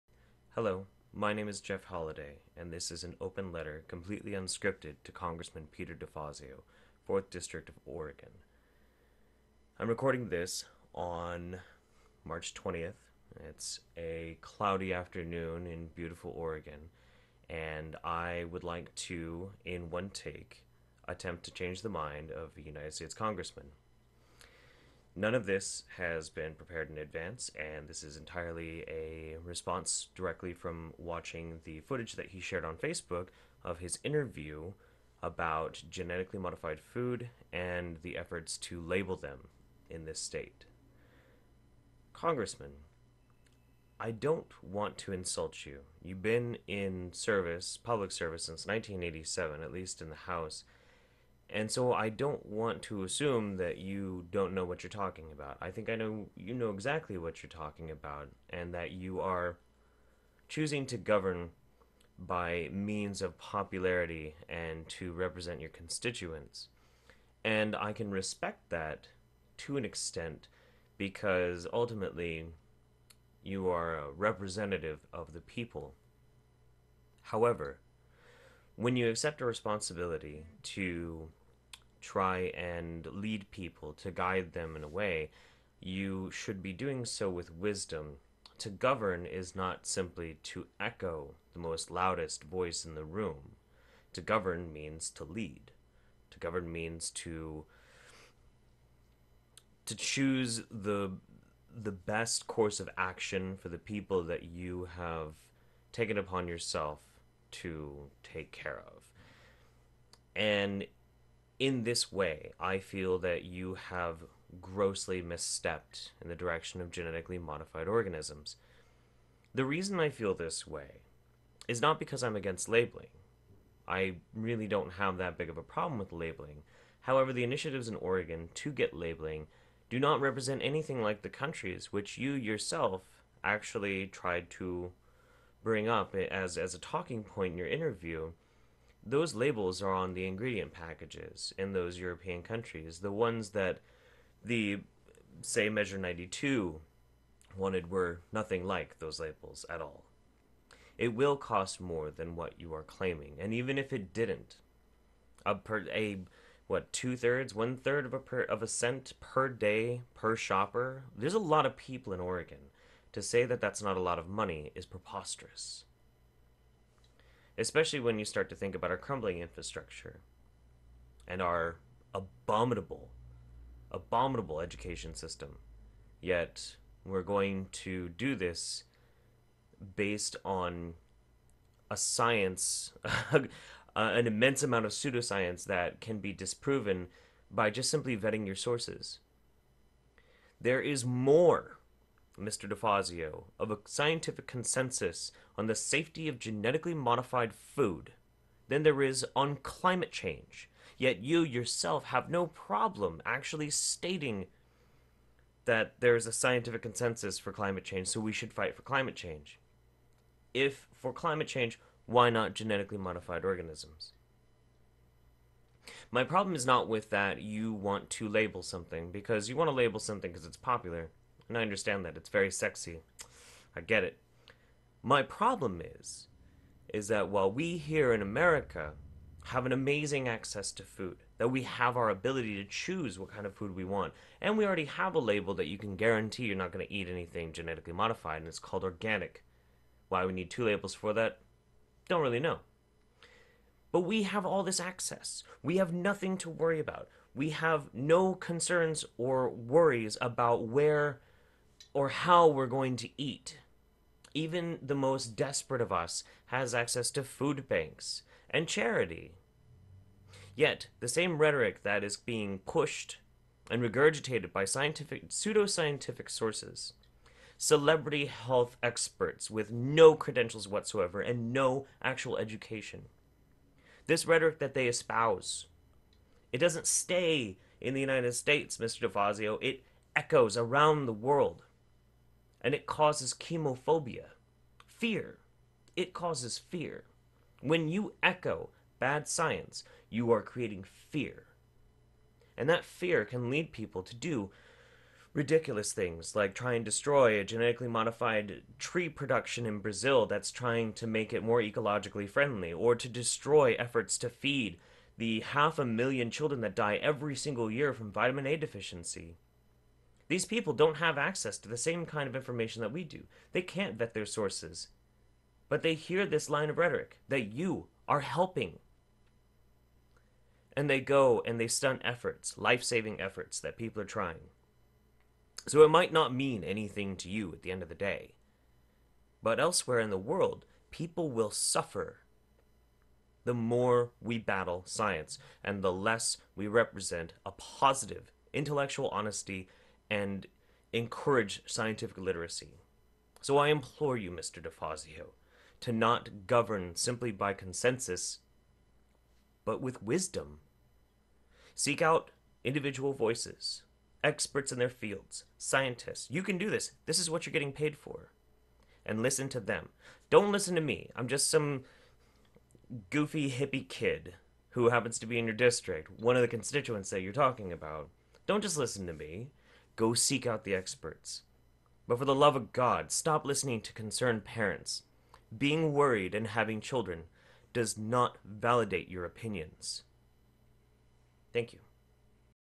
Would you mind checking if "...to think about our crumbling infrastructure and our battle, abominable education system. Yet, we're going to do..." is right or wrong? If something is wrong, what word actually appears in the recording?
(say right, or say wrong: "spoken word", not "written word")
wrong: "abominable", not "battle".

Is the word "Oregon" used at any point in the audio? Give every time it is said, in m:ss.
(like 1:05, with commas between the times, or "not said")
0:07, 0:16, 2:07, 2:42.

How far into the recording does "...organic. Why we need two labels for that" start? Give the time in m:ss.
3:58.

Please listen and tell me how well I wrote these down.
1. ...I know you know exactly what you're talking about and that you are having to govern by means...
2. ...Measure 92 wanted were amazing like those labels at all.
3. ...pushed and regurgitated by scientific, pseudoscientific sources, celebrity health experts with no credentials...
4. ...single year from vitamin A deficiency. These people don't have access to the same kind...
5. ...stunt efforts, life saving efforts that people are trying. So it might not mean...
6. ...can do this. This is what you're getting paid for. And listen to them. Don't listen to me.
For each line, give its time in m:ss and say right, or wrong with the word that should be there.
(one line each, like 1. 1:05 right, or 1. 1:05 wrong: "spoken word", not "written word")
1. 0:55 wrong: "choosing", not "having"
2. 2:25 wrong: "nothing", not "amazing"
3. 4:22 right
4. 5:07 right
5. 5:21 right
6. 5:56 right.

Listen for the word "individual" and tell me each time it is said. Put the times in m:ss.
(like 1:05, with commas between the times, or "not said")
5:52.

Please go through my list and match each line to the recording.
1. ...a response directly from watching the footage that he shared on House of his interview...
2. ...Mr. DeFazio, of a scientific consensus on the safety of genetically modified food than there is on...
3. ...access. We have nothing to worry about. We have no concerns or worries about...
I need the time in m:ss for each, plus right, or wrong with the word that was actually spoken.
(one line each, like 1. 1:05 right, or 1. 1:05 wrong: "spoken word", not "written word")
1. 0:28 wrong: "Facebook", not "House"
2. 3:12 right
3. 4:04 right.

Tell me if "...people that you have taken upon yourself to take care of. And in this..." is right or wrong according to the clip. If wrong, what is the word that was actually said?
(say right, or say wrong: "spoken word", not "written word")
right.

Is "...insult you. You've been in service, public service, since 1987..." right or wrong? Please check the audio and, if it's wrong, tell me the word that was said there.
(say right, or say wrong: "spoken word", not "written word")
right.